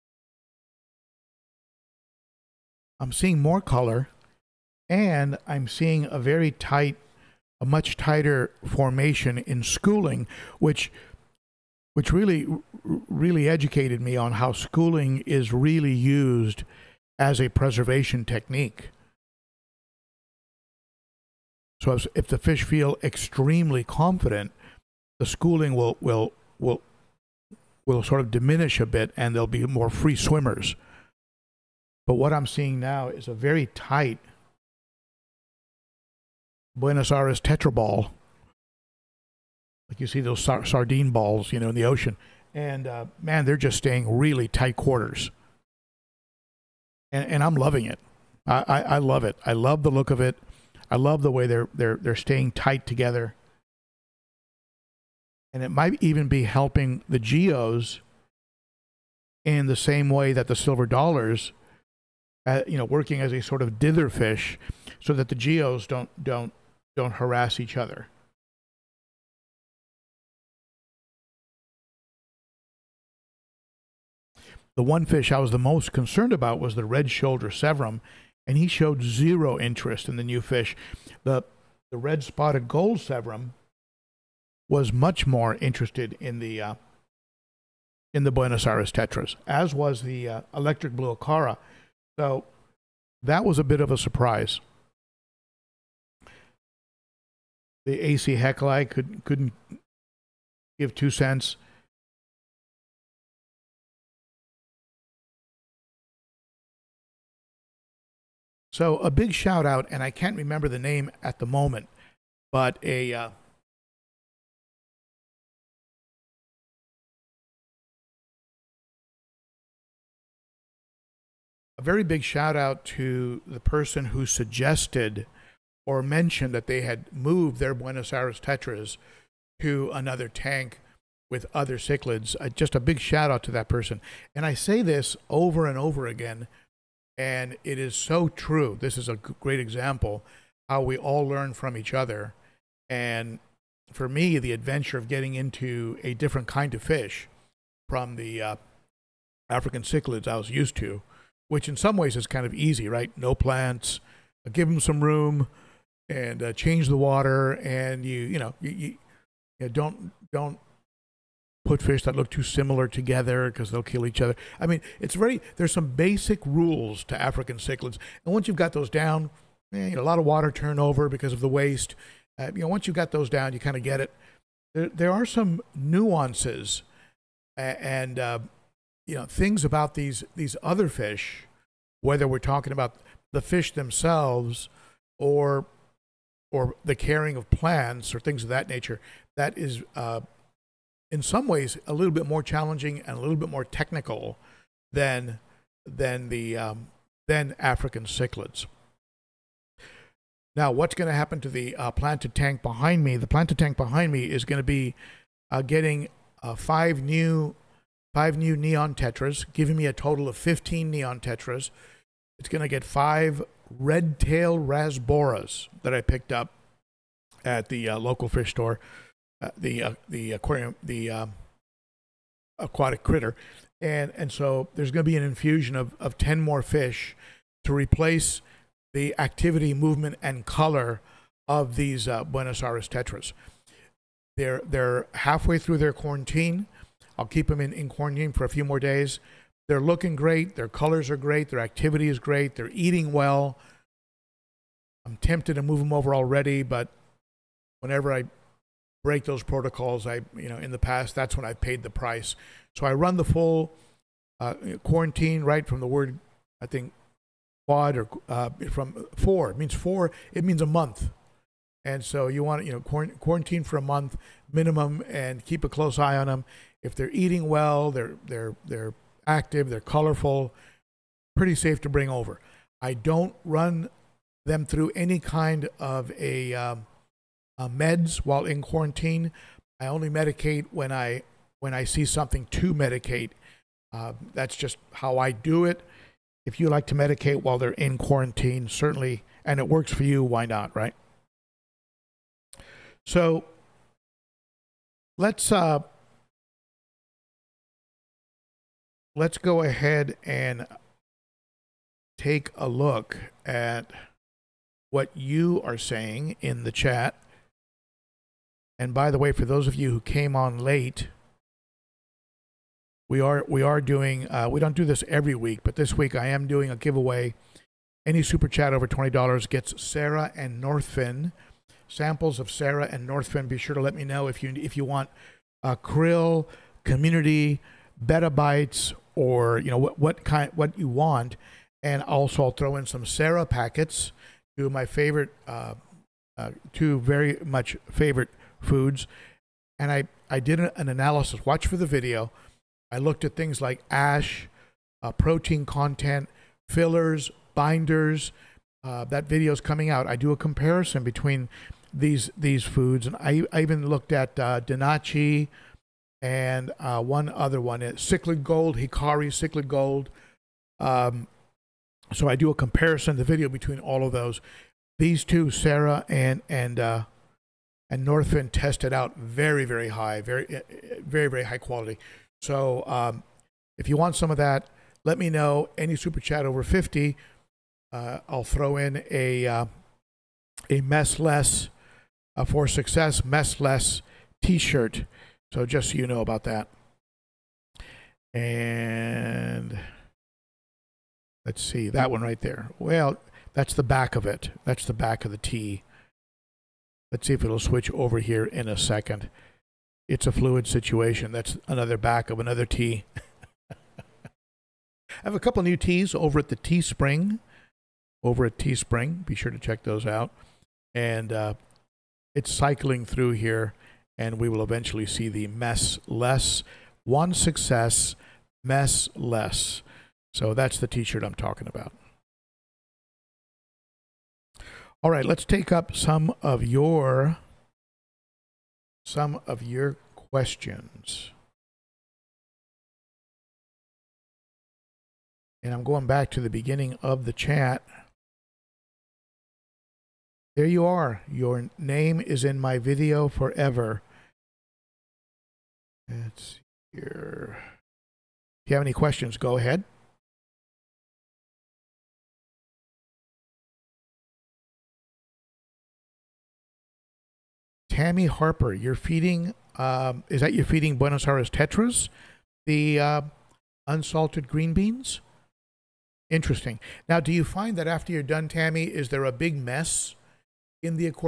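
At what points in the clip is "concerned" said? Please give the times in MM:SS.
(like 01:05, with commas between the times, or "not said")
01:15.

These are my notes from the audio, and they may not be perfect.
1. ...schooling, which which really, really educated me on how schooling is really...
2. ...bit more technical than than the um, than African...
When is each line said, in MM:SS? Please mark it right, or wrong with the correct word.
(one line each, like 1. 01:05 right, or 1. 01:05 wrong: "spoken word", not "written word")
1. 00:09 right
2. 03:13 right.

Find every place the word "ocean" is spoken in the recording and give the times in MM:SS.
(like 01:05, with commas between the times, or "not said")
00:41.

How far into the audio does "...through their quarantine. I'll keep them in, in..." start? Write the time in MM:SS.
03:55.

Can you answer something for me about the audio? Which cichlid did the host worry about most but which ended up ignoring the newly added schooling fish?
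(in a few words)
red shoulder severum.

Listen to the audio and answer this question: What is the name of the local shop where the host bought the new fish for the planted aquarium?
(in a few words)
aquatic critter.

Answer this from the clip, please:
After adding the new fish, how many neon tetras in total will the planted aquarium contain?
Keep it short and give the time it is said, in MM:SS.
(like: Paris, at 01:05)
15, at 03:30.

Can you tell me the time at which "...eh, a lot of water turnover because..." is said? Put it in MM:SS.
02:49.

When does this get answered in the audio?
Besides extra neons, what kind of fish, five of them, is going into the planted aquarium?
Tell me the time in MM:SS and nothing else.
03:33.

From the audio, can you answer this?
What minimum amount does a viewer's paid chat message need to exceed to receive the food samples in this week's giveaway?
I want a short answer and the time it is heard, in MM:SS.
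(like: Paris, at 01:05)
$20, at 05:18.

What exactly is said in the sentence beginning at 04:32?
I don't run them through any kind of a um, uh, meds while in quarantine.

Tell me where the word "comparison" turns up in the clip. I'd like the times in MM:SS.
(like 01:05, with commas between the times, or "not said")
05:50, 06:02.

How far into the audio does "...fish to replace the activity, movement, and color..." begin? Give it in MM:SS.
03:46.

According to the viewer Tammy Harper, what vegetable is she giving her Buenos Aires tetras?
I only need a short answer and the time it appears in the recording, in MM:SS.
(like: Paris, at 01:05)
unsalted green beans, at 07:43.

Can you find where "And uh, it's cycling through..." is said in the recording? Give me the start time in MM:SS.
06:50.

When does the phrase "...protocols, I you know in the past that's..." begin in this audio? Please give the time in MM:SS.
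04:09.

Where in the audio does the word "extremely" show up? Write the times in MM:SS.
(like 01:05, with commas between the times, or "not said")
00:23.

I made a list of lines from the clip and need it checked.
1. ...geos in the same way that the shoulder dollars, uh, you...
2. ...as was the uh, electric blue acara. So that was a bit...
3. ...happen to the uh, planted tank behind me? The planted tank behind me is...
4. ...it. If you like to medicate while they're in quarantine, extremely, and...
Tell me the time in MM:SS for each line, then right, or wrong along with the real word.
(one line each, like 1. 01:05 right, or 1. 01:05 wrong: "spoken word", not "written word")
1. 00:57 wrong: "silver", not "shoulder"
2. 01:29 right
3. 03:21 right
4. 04:45 wrong: "certainly", not "extremely".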